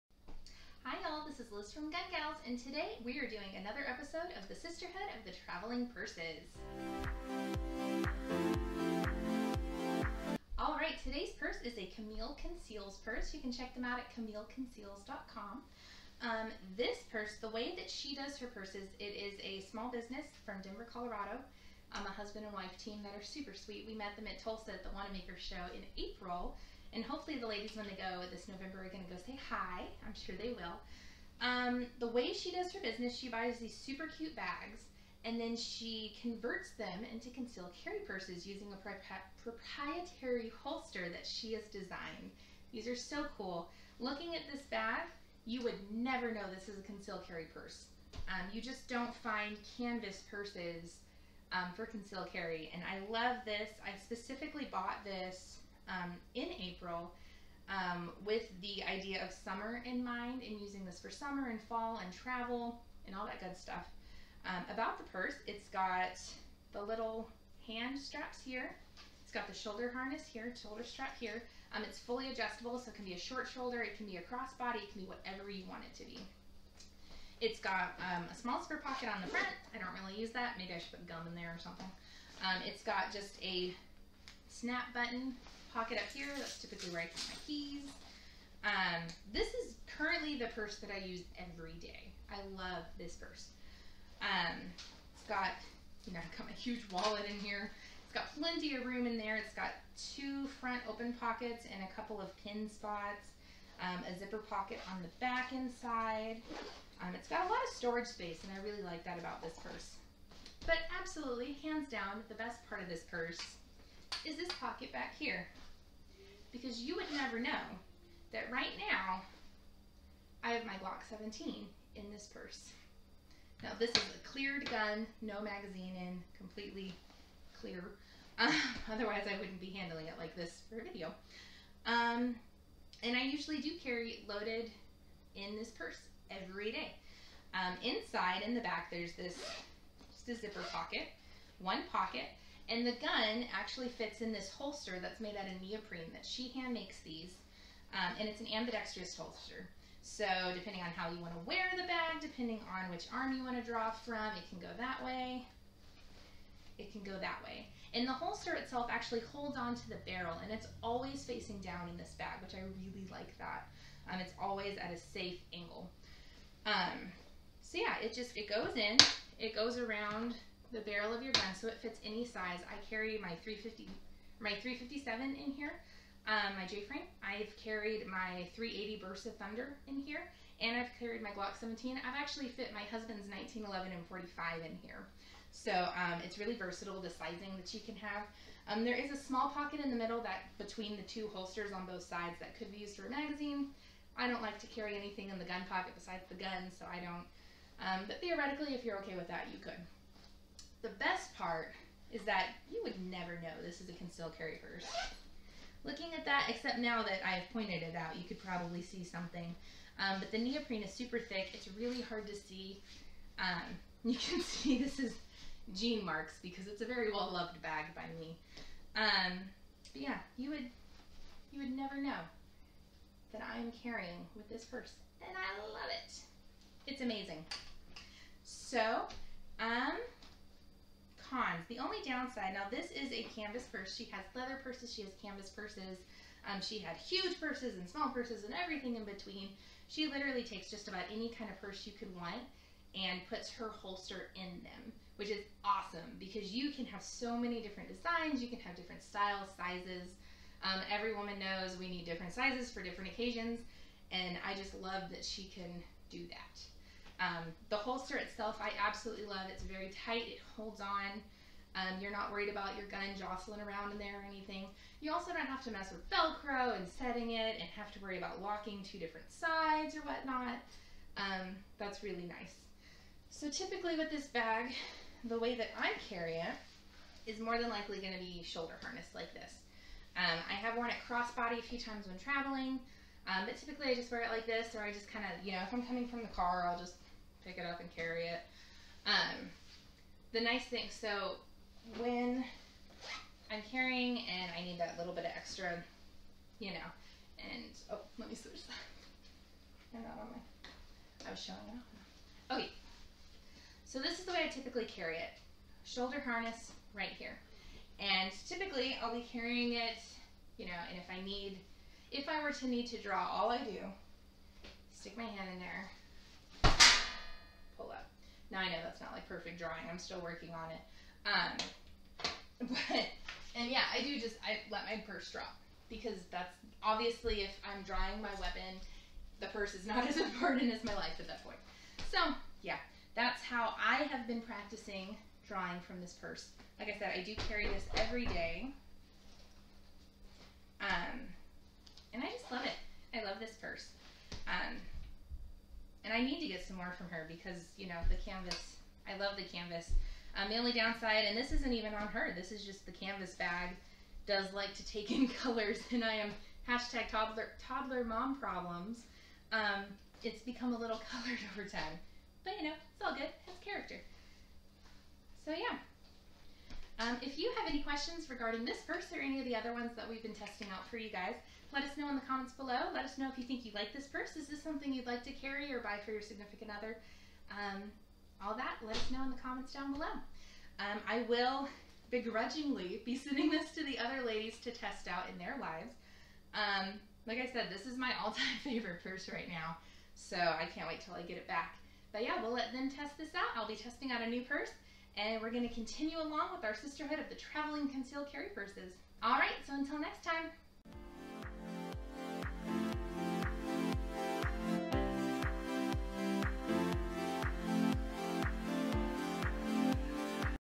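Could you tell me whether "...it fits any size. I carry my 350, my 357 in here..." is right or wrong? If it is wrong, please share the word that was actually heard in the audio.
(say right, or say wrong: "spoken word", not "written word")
right.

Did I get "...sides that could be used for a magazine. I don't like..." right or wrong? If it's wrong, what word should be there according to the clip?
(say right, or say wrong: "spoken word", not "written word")
right.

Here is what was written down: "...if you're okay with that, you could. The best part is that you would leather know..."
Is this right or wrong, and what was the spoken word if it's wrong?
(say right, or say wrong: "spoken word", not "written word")
wrong: "never", not "leather".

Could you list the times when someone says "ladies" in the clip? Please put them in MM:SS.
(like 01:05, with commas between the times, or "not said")
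00:27, 06:24.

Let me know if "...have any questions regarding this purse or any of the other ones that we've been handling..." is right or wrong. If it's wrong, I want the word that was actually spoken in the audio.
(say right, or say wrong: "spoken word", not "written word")
wrong: "testing", not "handling".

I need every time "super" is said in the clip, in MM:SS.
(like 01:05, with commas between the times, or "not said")
00:23, 00:33, 03:30.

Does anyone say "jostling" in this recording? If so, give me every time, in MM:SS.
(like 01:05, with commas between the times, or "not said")
04:23.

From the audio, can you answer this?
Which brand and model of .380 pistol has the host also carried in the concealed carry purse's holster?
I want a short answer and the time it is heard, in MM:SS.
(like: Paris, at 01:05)
Bersa Thunder, at 02:59.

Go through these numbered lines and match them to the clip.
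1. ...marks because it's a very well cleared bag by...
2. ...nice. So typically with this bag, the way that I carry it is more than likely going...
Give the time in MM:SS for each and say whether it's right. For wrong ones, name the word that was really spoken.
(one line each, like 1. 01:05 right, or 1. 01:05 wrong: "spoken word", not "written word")
1. 03:36 wrong: "loved", not "cleared"
2. 04:32 right.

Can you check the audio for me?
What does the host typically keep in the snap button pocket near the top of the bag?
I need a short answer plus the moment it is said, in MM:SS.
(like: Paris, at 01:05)
Keys, at 01:27.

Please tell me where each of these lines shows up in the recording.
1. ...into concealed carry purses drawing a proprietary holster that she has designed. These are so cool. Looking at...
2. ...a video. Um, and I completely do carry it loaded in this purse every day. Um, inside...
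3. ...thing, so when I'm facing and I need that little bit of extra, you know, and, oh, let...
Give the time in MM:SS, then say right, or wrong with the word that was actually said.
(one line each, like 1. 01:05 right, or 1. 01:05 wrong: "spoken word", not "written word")
1. 00:37 wrong: "using", not "drawing"
2. 02:10 wrong: "usually", not "completely"
3. 04:50 wrong: "carrying", not "facing".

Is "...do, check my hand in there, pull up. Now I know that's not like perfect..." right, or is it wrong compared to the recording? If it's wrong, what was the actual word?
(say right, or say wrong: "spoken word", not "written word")
wrong: "stick", not "check".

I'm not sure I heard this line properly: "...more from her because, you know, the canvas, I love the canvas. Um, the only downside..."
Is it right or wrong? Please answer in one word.
right.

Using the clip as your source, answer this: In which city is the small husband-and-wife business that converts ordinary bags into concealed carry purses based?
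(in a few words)
Denver, Colorado.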